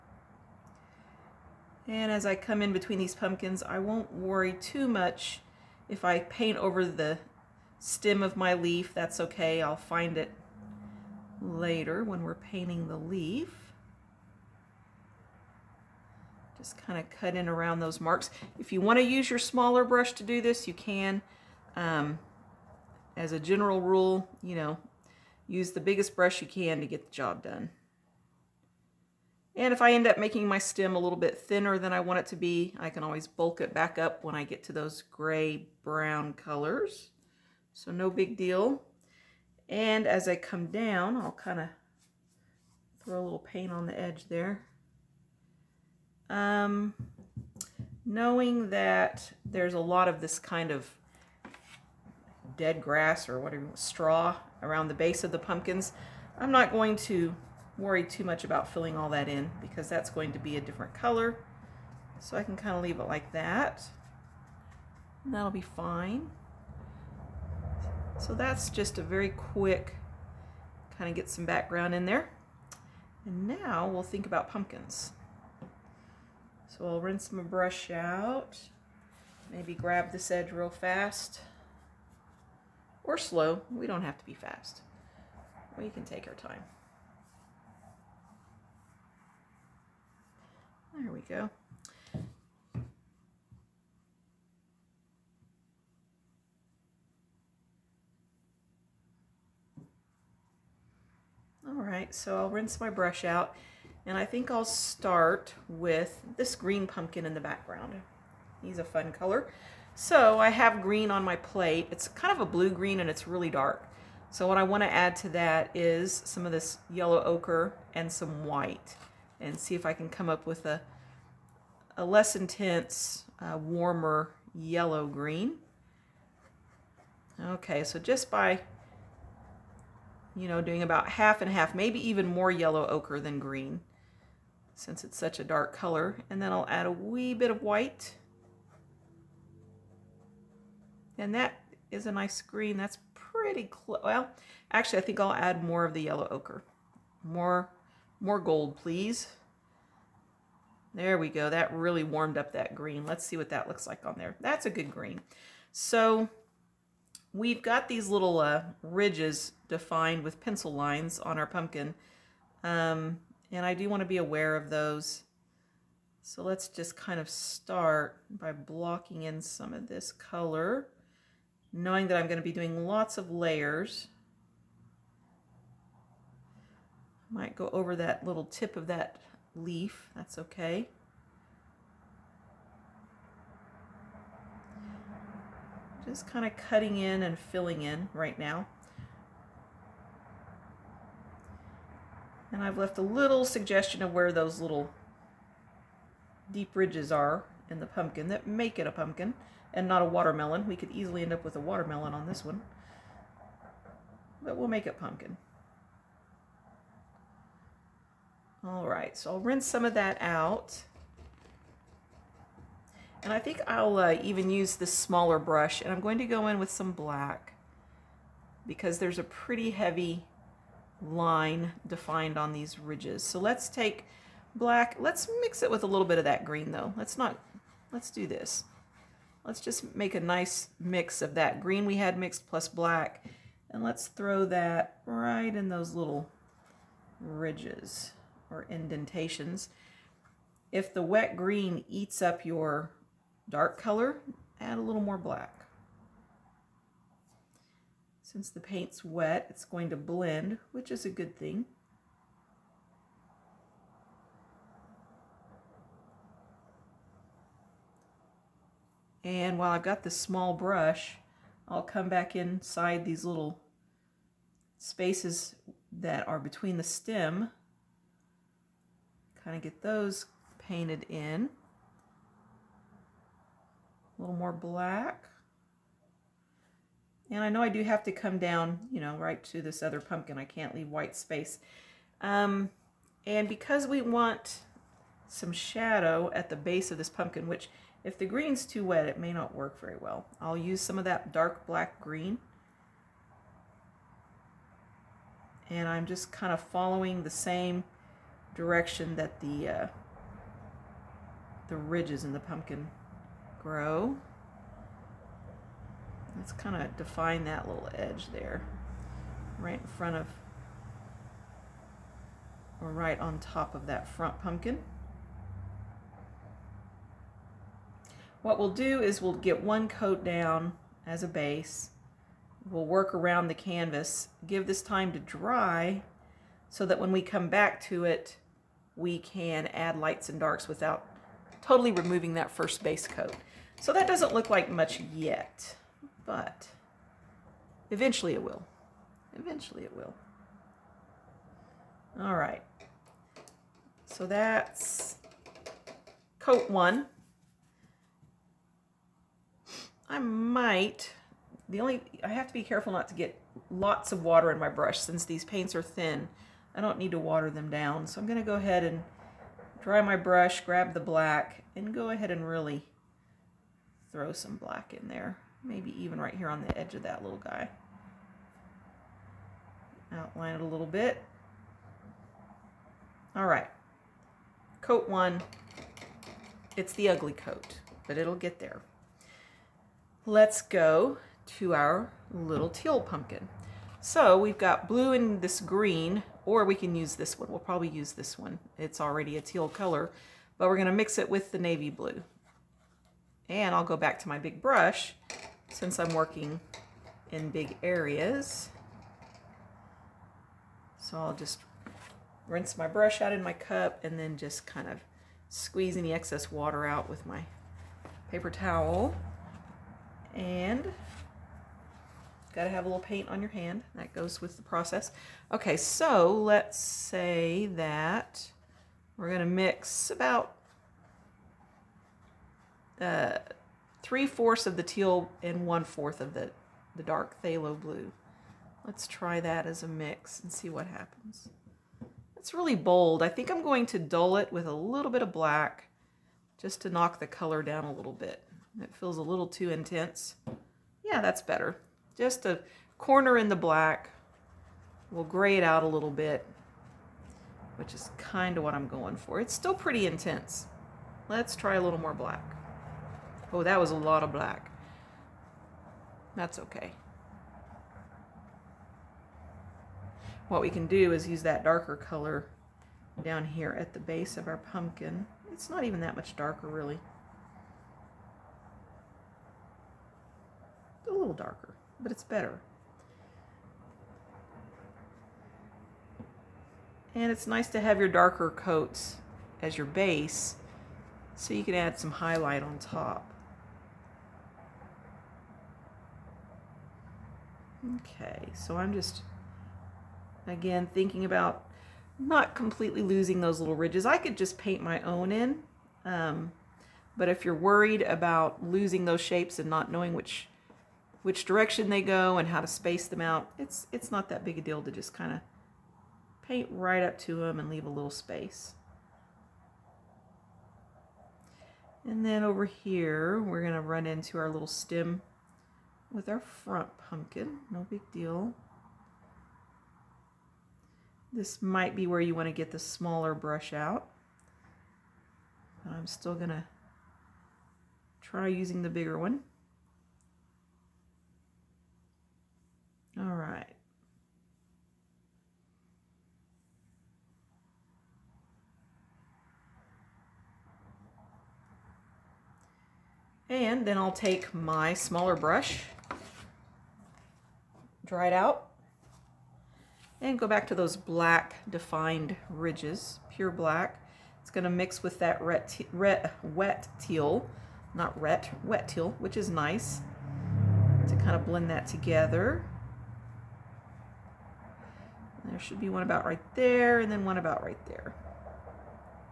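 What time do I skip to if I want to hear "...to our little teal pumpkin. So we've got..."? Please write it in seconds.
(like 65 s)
381 s.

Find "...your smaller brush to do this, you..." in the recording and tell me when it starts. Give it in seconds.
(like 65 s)
19 s.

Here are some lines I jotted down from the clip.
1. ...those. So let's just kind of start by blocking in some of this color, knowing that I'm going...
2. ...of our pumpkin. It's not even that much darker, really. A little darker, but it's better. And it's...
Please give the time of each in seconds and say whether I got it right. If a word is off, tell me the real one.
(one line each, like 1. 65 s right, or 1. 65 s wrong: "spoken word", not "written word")
1. 164 s right
2. 464 s right.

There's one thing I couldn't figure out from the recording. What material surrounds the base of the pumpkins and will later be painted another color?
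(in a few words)
Straw.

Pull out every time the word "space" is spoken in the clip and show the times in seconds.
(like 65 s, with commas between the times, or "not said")
264 s, 281 s, 502 s, 508 s.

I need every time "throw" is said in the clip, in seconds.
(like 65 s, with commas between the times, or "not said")
43 s, 234 s, 364 s.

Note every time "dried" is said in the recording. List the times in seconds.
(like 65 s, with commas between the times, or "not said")
548 s.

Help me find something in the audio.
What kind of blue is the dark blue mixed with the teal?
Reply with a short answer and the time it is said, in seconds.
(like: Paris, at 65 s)
Phthalo blue, at 427 s.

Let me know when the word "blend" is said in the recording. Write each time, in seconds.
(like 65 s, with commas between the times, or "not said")
249 s, 561 s.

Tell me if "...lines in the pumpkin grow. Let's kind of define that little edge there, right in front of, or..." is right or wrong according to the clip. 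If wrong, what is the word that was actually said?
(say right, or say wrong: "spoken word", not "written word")
wrong: "ridges", not "lines".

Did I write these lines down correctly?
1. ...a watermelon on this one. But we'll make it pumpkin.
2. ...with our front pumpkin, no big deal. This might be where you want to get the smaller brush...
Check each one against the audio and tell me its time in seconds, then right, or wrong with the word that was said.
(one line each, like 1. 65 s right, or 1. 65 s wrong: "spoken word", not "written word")
1. 201 s right
2. 516 s right.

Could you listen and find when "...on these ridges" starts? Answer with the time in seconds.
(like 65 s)
222 s.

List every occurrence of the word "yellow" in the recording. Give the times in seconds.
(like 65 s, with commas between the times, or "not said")
116 s, 124 s, 132 s, 146 s.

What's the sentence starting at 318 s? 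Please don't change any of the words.
What we'll do is we'll get one coat down as a base.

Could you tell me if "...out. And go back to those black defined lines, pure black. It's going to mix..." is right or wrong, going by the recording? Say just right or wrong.
wrong.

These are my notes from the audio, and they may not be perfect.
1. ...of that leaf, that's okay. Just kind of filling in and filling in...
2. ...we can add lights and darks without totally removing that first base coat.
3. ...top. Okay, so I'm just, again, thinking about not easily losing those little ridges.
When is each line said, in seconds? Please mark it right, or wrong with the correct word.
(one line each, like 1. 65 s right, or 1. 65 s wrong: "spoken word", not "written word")
1. 178 s wrong: "cutting", not "filling"
2. 328 s right
3. 482 s wrong: "completely", not "easily".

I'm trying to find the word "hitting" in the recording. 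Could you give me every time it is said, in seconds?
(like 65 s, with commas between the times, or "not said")
not said.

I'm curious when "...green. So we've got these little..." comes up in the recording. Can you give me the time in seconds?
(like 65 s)
154 s.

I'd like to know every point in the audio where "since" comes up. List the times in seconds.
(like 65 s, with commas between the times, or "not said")
134 s, 248 s, 354 s, 395 s.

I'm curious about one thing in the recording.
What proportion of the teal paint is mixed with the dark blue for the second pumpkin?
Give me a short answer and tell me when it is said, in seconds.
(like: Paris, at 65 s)
Three fourths, at 424 s.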